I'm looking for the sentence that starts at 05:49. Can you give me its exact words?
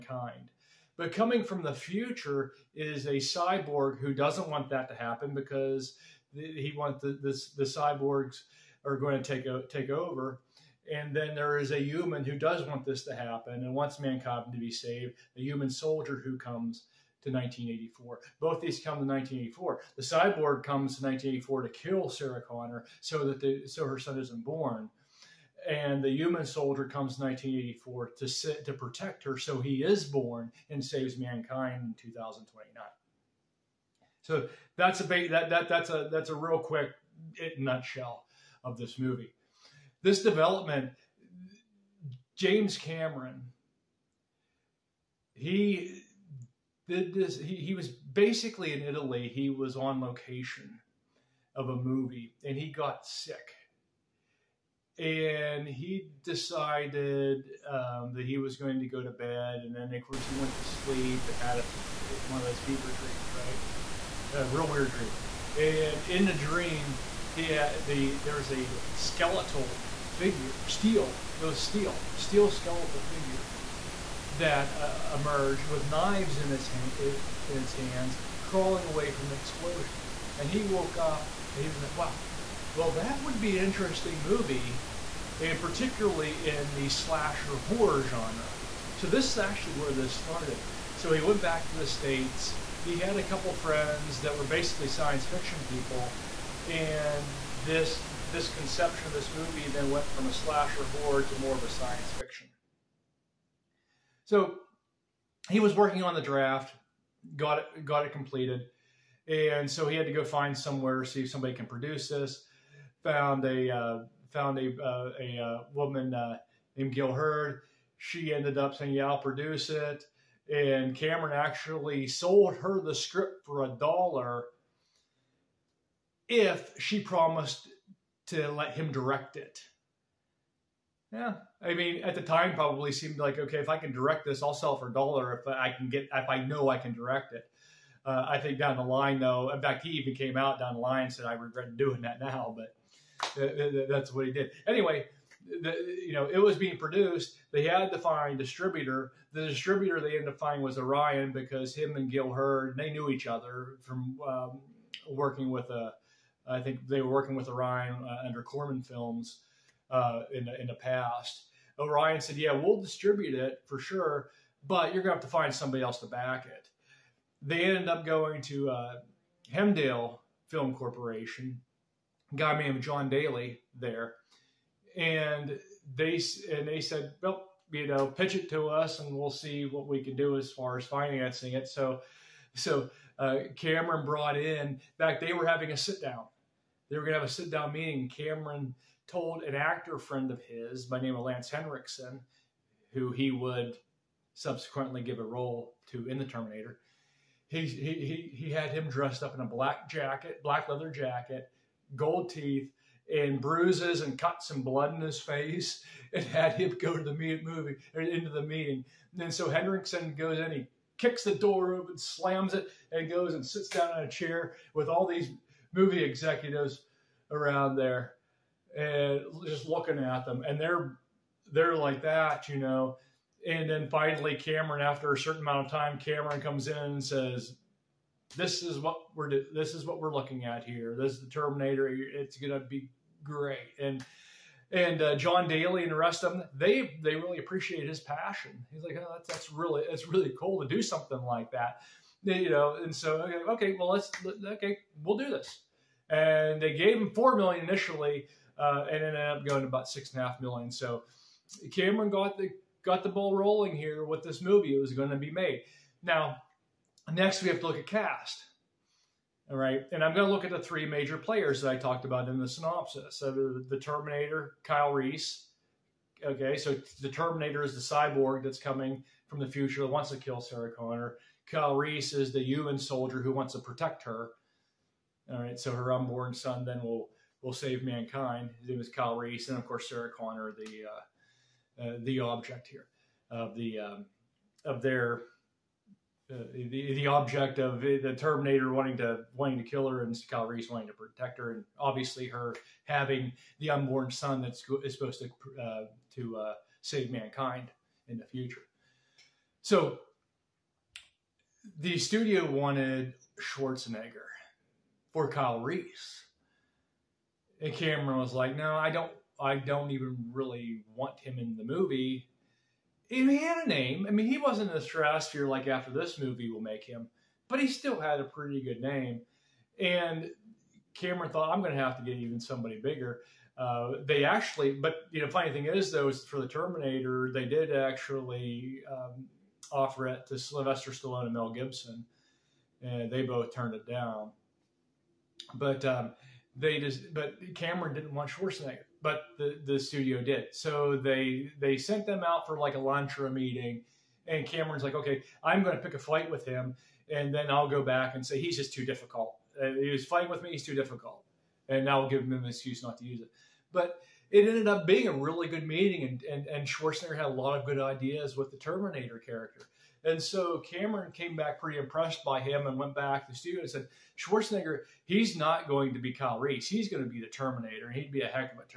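Uh, he was fighting with me; he's too difficult, and now we'll give him an excuse not to use it.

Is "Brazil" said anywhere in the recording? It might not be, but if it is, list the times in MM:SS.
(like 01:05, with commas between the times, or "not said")
not said.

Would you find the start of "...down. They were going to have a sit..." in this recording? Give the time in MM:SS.
03:06.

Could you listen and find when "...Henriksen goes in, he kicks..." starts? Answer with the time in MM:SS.
03:29.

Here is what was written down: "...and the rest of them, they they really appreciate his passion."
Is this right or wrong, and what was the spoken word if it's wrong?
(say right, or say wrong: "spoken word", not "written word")
right.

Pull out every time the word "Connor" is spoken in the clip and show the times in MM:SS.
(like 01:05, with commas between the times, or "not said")
00:22, 04:30, 04:40.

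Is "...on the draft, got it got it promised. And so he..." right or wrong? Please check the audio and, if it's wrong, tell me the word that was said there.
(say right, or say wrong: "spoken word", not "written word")
wrong: "completed", not "promised".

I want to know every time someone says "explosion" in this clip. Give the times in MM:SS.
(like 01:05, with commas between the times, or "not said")
01:19.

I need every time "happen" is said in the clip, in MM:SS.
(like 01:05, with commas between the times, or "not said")
00:04, 00:13.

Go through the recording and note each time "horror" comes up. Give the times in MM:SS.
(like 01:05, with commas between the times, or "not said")
01:27, 01:40.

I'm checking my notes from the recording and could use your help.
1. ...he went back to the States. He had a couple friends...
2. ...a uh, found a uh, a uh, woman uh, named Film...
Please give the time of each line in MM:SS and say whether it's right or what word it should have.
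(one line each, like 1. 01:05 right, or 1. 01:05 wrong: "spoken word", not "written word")
1. 01:31 right
2. 01:53 wrong: "Gale", not "Film".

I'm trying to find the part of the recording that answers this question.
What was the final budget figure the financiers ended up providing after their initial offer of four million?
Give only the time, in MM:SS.
04:09.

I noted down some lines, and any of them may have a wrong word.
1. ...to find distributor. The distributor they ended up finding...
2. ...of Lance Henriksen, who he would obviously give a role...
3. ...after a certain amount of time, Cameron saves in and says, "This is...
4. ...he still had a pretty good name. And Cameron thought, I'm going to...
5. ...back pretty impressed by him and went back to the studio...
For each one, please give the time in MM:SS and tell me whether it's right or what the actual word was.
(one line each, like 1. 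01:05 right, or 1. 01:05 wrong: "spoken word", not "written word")
1. 02:27 right
2. 03:11 wrong: "subsequently", not "obviously"
3. 03:44 wrong: "comes", not "saves"
4. 05:17 right
5. 06:01 right.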